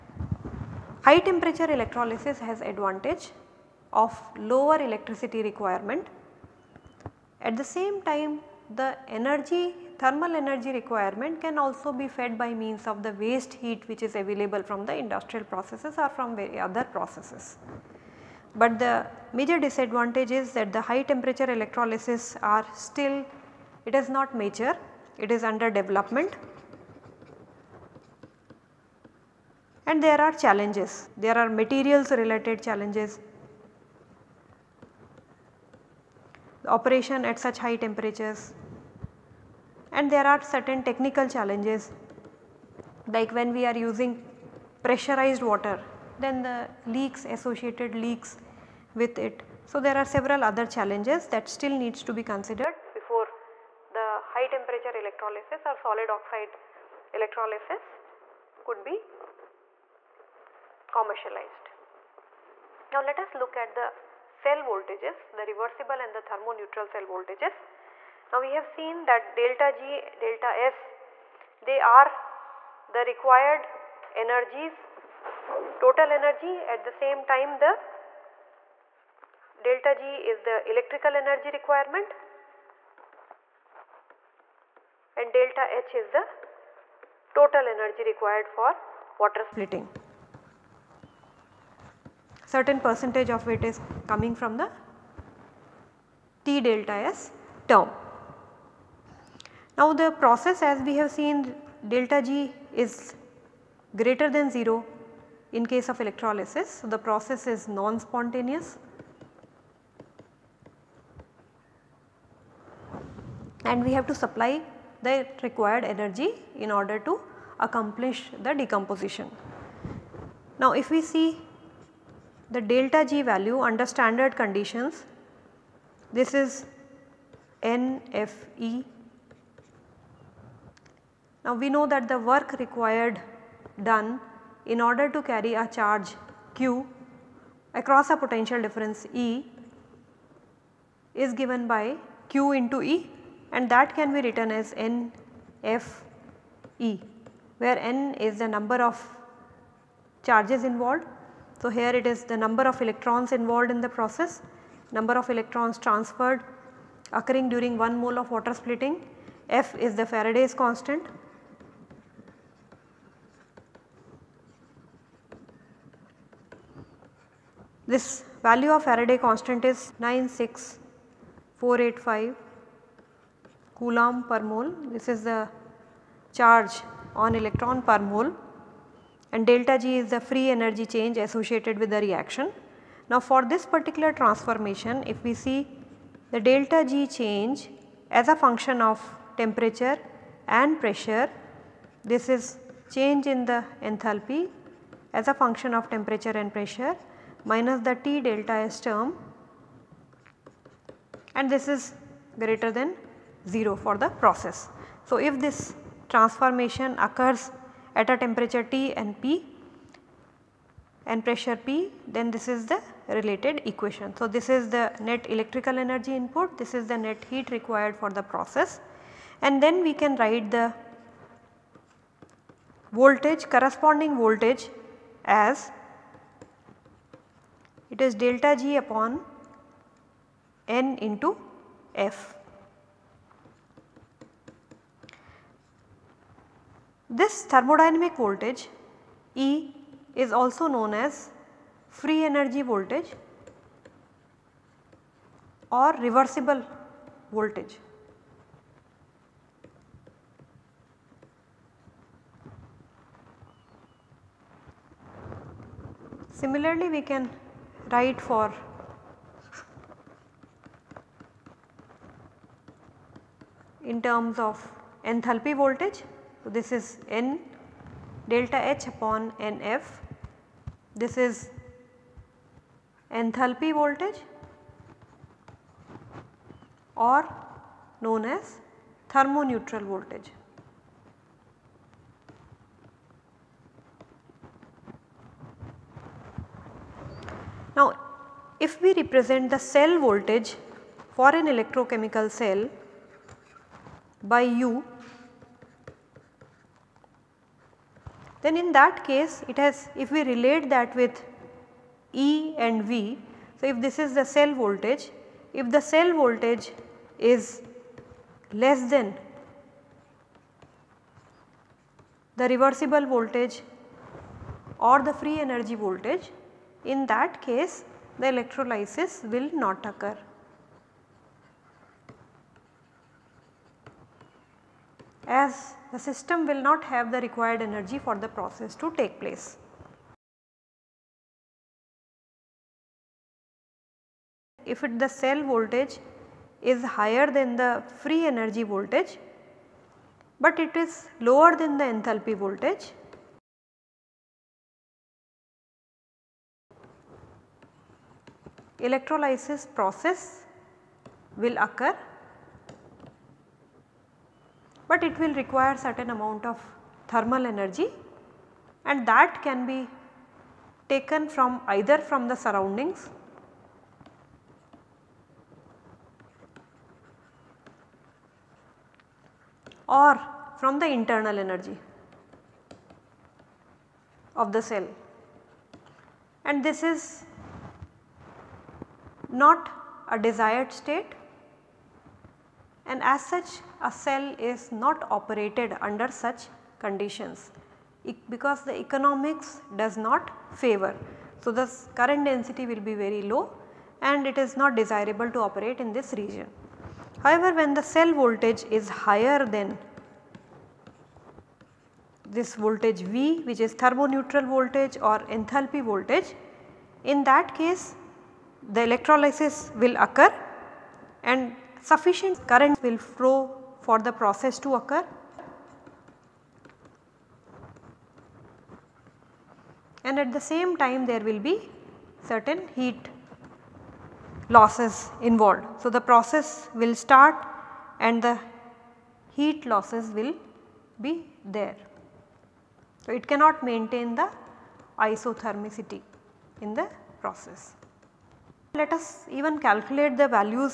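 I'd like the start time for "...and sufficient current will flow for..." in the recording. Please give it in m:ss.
6:51.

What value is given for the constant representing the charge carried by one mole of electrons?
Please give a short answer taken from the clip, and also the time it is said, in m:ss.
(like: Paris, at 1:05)
96485 coulomb per mole, at 2:49.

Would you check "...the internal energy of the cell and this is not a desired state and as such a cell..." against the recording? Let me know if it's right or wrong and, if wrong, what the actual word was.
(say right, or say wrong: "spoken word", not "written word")
right.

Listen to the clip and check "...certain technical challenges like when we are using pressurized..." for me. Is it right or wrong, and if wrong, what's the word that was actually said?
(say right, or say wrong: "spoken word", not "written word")
right.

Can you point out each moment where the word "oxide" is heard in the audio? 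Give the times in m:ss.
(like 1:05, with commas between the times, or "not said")
0:56.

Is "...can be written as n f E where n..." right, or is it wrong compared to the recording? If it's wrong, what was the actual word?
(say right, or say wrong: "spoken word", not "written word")
right.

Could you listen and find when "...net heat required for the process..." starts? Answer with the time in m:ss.
3:36.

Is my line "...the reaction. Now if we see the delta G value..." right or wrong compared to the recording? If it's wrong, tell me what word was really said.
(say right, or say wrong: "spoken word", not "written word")
wrong: "decomposition", not "reaction".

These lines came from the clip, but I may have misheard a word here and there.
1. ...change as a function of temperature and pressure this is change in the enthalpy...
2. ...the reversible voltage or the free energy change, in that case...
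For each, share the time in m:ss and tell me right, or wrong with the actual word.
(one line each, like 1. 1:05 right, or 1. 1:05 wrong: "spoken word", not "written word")
1. 3:07 right
2. 5:12 wrong: "voltage", not "change".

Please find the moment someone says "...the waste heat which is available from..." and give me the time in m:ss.
0:13.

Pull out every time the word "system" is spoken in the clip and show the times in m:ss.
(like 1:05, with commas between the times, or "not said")
5:26.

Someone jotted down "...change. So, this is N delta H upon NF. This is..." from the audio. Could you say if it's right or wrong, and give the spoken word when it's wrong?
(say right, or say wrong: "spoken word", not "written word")
wrong: "voltage", not "change".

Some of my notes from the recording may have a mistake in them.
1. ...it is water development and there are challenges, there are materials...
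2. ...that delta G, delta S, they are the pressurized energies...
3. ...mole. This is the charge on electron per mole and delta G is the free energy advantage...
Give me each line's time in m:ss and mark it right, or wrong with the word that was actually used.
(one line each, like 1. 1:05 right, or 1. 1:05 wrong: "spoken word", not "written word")
1. 0:25 wrong: "under", not "water"
2. 1:09 wrong: "required", not "pressurized"
3. 2:54 wrong: "change", not "advantage".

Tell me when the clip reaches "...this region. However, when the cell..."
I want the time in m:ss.
6:35.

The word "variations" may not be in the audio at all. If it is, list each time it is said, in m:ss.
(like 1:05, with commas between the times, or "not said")
not said.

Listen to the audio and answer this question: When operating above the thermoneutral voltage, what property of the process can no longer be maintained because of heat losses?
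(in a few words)
Isothermicity.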